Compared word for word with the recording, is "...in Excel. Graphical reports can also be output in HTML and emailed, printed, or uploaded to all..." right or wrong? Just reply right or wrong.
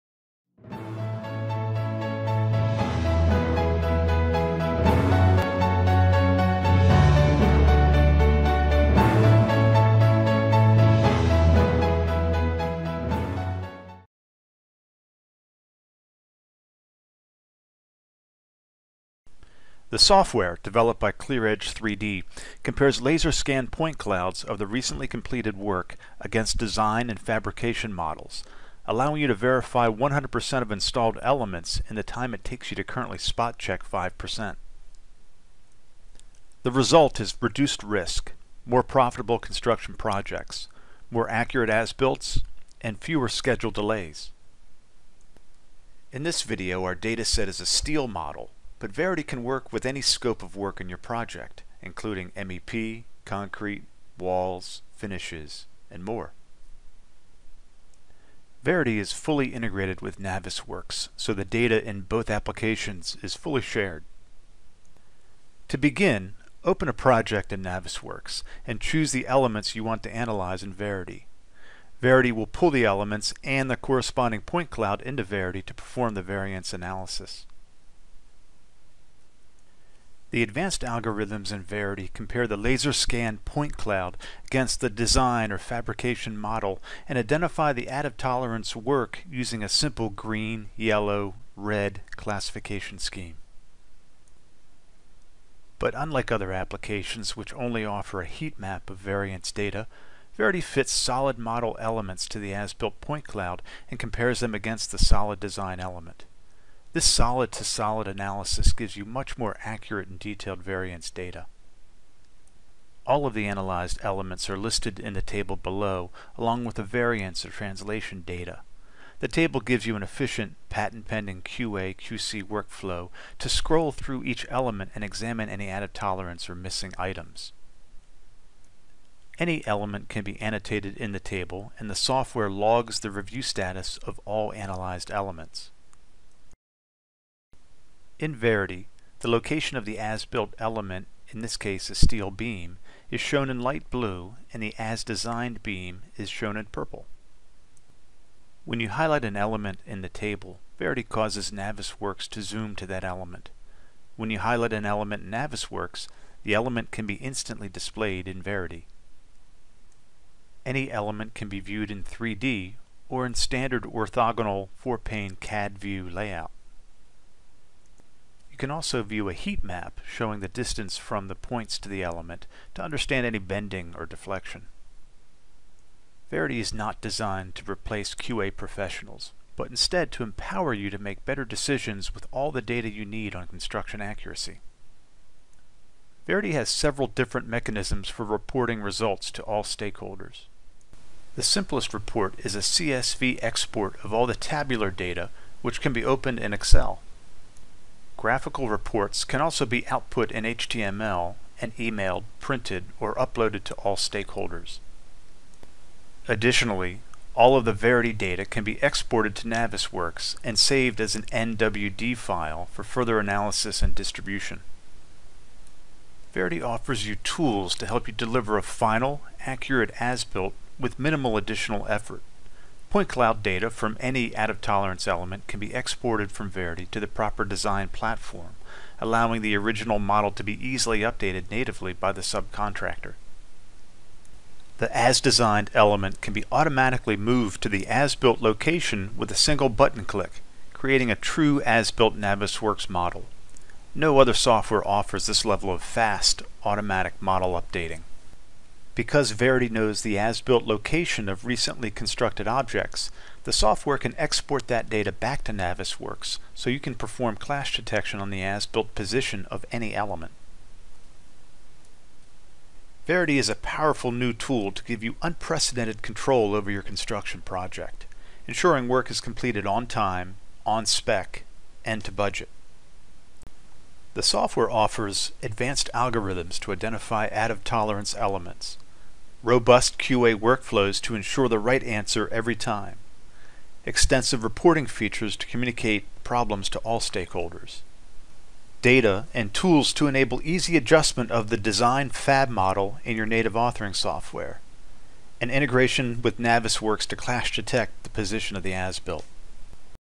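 right.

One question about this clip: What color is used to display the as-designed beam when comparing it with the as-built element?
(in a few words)
purple.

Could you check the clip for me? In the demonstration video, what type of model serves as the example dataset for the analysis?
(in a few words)
steel model.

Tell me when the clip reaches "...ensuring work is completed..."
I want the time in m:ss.
4:28.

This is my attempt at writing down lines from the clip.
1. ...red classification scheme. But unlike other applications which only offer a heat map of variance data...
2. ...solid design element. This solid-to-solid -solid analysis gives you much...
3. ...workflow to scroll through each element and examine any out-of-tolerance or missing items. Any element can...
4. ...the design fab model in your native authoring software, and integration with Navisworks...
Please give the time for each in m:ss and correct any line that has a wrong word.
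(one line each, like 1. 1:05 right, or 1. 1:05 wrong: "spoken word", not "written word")
1. 1:31 right
2. 1:44 right
3. 2:02 right
4. 4:51 right.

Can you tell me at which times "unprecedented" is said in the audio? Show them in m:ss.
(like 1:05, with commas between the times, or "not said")
4:25.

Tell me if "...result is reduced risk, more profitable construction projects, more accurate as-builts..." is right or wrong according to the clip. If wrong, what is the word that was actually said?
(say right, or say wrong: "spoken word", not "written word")
right.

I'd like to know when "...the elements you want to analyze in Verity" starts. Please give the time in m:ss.
1:09.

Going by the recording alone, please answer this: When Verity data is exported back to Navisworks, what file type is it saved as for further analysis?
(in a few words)
NWD.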